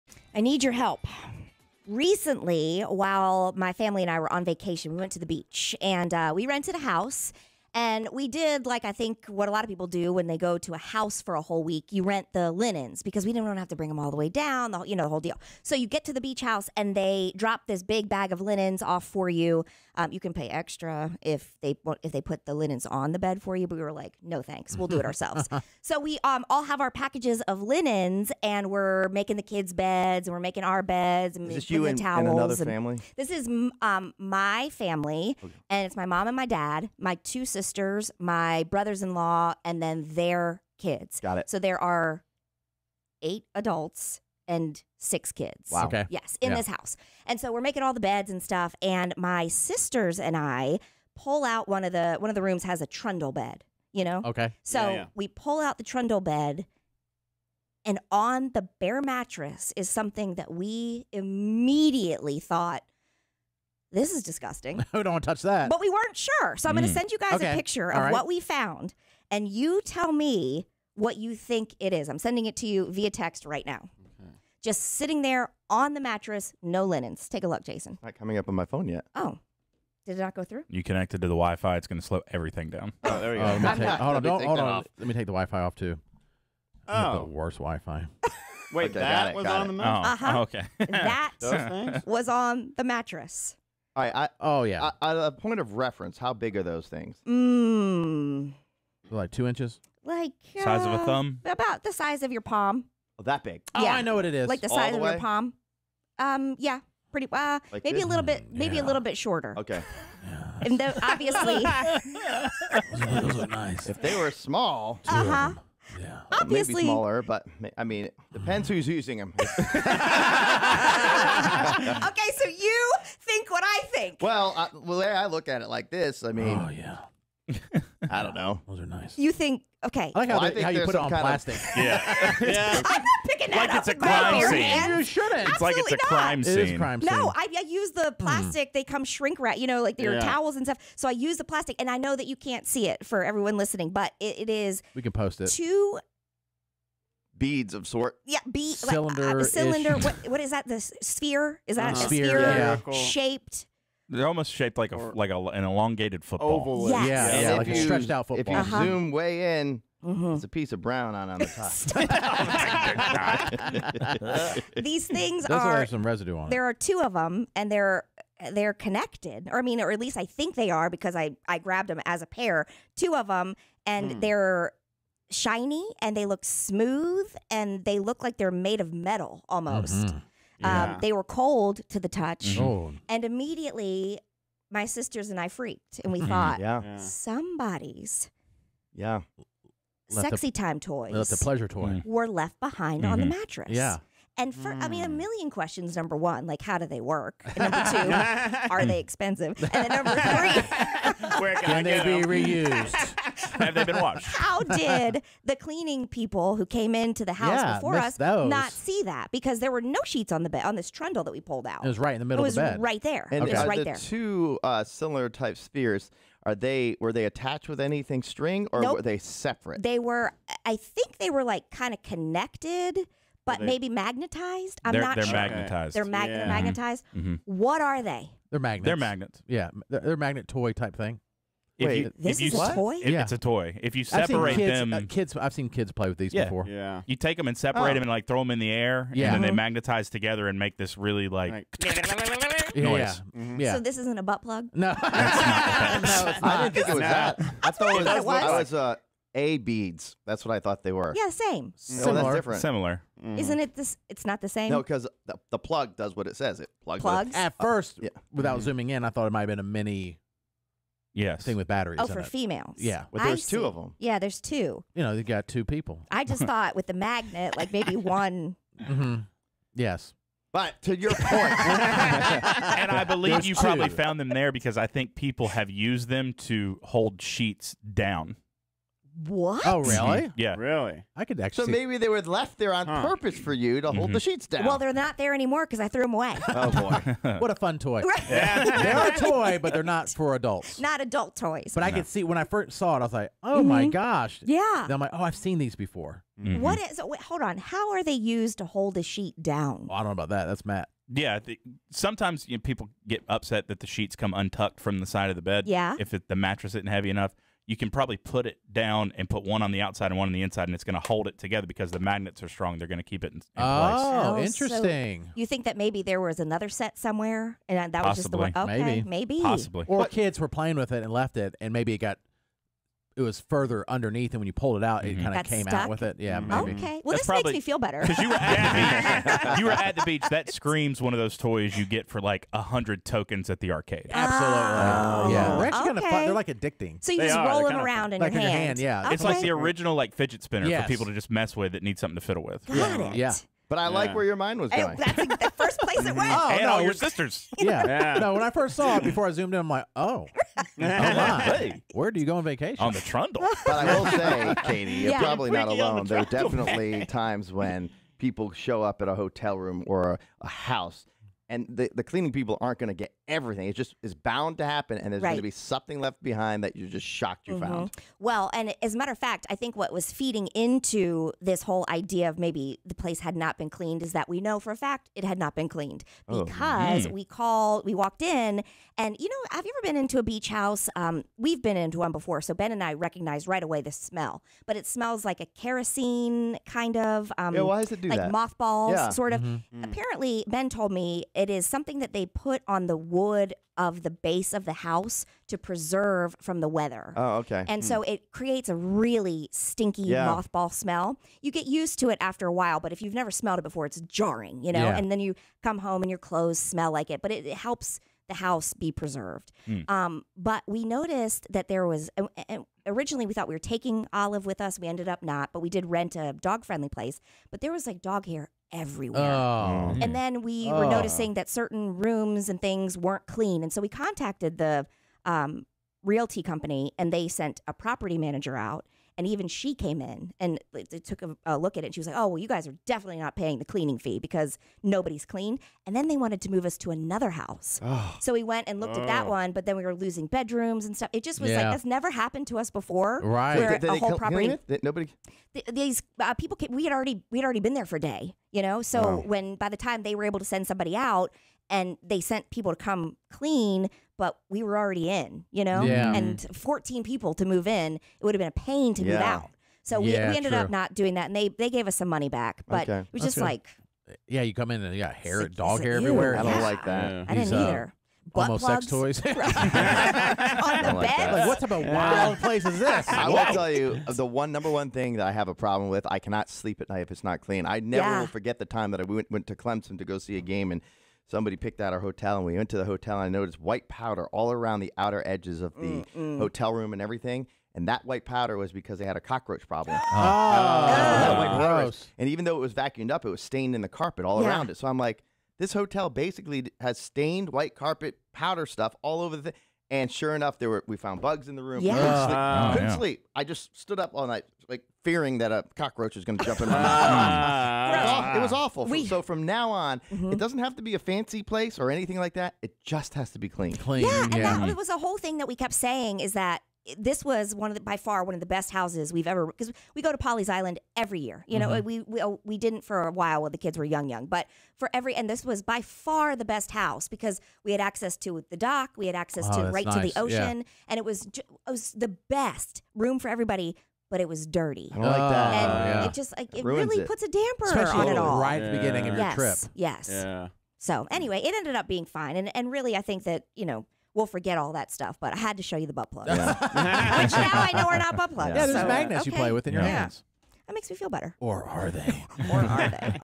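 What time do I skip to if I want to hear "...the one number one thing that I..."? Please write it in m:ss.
7:54.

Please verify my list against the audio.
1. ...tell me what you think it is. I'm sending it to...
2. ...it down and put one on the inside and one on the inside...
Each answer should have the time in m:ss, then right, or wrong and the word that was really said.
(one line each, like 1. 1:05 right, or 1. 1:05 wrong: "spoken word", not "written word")
1. 1:09 right
2. 5:08 wrong: "outside", not "inside".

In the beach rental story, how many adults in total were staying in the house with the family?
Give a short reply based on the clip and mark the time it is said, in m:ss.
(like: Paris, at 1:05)
8, at 0:43.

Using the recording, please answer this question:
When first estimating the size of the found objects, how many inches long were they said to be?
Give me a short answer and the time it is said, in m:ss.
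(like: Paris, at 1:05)
2 inches, at 1:39.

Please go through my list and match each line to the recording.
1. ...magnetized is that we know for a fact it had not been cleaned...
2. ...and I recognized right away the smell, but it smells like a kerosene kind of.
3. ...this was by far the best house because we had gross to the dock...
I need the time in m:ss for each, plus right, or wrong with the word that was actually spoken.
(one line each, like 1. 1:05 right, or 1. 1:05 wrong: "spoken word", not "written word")
1. 6:13 wrong: "cleaned", not "magnetized"
2. 6:22 right
3. 8:45 wrong: "access", not "gross".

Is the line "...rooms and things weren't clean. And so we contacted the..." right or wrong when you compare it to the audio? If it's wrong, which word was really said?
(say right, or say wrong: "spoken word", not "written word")
right.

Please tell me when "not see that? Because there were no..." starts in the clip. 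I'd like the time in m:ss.
3:28.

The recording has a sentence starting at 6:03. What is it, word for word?
It's just is bound to happen, and there's right.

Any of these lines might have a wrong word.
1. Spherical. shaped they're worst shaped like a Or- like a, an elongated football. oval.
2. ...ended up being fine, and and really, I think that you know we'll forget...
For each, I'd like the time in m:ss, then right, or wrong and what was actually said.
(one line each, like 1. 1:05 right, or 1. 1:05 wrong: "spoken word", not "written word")
1. 2:32 wrong: "almost", not "worst"
2. 9:01 right.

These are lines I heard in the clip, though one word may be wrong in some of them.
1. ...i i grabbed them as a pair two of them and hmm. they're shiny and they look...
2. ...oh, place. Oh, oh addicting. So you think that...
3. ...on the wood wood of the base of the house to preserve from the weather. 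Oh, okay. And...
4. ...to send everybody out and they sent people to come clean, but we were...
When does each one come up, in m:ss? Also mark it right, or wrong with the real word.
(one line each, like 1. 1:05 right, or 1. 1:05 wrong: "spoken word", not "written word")
1. 2:51 right
2. 5:13 wrong: "interesting", not "addicting"
3. 6:32 right
4. 7:30 wrong: "somebody", not "everybody".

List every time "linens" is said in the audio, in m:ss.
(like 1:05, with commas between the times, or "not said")
0:12, 0:18, 0:22, 0:27, 1:16.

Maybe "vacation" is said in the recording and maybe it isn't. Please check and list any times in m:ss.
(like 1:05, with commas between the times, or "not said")
0:04, 5:52.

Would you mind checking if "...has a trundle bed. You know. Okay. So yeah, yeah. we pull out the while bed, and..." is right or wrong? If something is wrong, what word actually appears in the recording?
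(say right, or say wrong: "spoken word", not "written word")
wrong: "trundle", not "while".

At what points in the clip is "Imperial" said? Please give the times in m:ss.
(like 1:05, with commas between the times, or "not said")
not said.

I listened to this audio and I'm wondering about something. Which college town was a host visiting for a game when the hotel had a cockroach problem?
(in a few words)
Clemson.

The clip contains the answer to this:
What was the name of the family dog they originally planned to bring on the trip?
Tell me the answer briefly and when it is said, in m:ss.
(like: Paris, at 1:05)
Olive, at 6:54.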